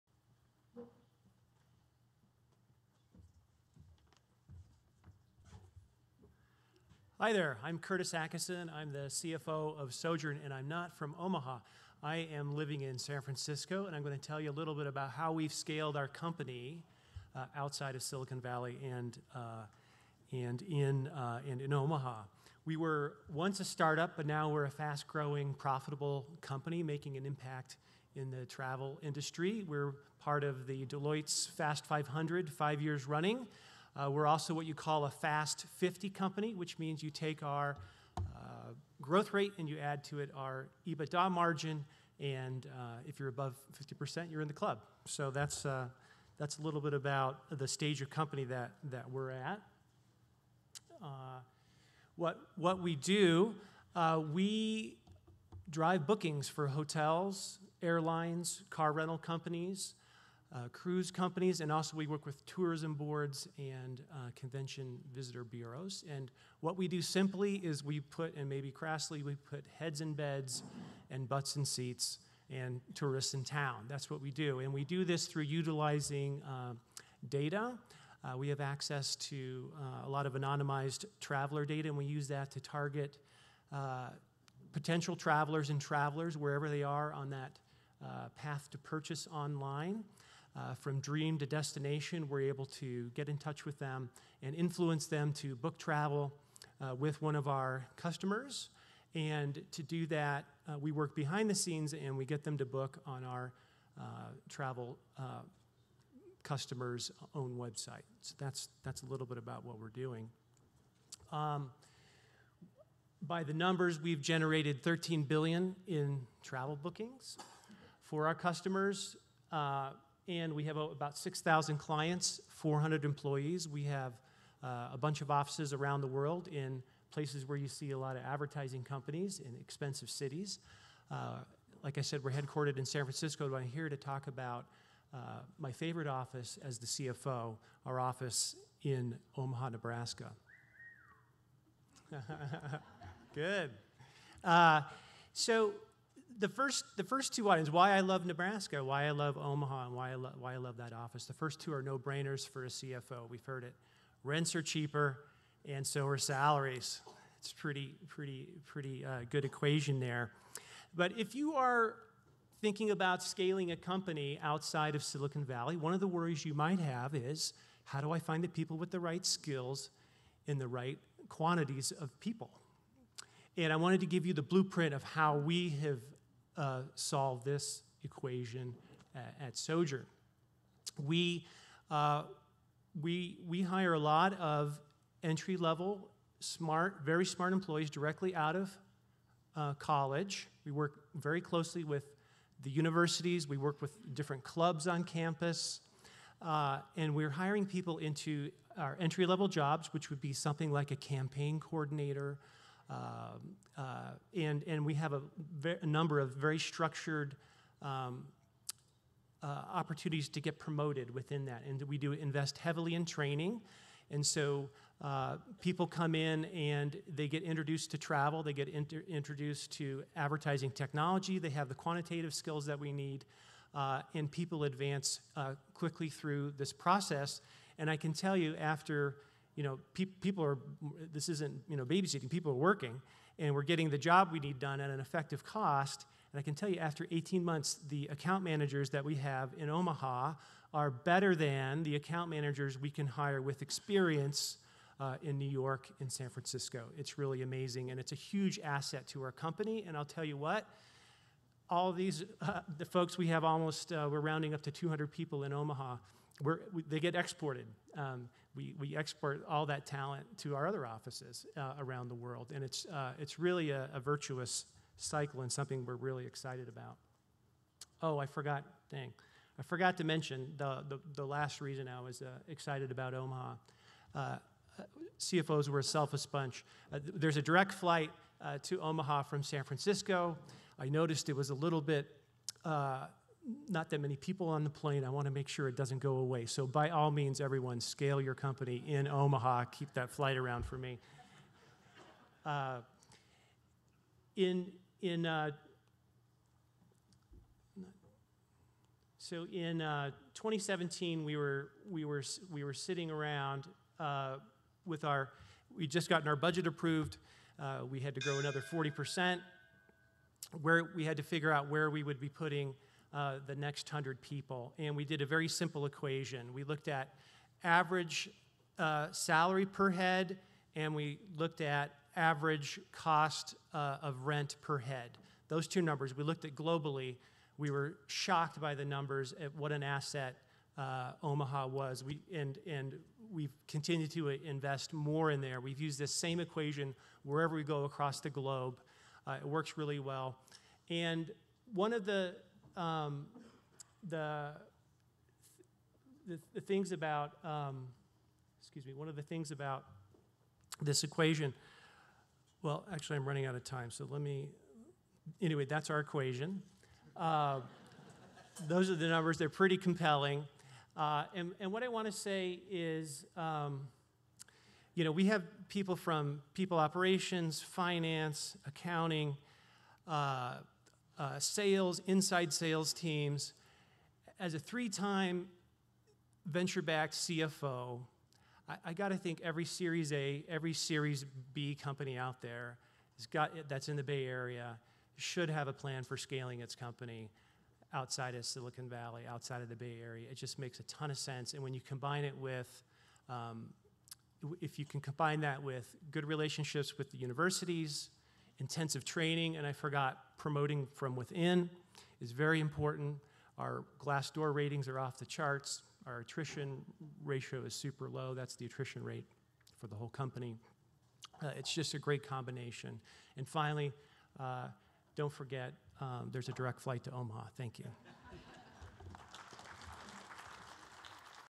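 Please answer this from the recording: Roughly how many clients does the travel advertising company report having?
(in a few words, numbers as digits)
6,000.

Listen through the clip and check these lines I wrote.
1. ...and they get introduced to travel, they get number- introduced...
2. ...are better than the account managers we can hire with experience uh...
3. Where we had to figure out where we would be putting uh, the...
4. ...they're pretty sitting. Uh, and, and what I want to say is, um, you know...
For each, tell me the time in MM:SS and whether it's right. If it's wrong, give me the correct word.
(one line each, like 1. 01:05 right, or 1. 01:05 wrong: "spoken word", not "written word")
1. 03:36 wrong: "inter", not "number"
2. 04:00 right
3. 05:10 right
4. 05:59 wrong: "compelling", not "sitting".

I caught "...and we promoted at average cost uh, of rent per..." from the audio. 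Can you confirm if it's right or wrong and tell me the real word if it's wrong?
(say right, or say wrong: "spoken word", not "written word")
wrong: "looked", not "promoted".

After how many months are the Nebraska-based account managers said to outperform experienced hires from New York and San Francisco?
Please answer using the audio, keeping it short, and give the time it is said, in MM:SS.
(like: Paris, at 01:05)
18 months, at 03:57.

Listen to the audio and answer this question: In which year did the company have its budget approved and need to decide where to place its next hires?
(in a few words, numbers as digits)
2017.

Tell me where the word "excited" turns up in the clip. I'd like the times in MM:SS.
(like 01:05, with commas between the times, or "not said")
04:26, 04:32.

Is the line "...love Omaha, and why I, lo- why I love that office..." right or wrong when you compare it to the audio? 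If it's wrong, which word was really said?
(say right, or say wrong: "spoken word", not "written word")
right.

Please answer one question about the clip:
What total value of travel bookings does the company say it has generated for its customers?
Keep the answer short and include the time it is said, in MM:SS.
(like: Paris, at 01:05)
13 billion, at 01:54.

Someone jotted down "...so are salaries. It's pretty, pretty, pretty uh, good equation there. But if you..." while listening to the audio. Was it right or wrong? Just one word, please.
right.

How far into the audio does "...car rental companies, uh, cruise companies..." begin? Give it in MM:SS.
00:58.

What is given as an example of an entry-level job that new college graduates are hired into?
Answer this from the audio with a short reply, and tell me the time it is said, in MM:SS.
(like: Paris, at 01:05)
Campaign coordinator, at 03:20.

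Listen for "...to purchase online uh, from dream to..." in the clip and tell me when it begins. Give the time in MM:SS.
01:28.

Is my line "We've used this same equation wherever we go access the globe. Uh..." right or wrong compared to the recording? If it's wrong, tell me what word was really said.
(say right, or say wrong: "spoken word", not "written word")
wrong: "across", not "access".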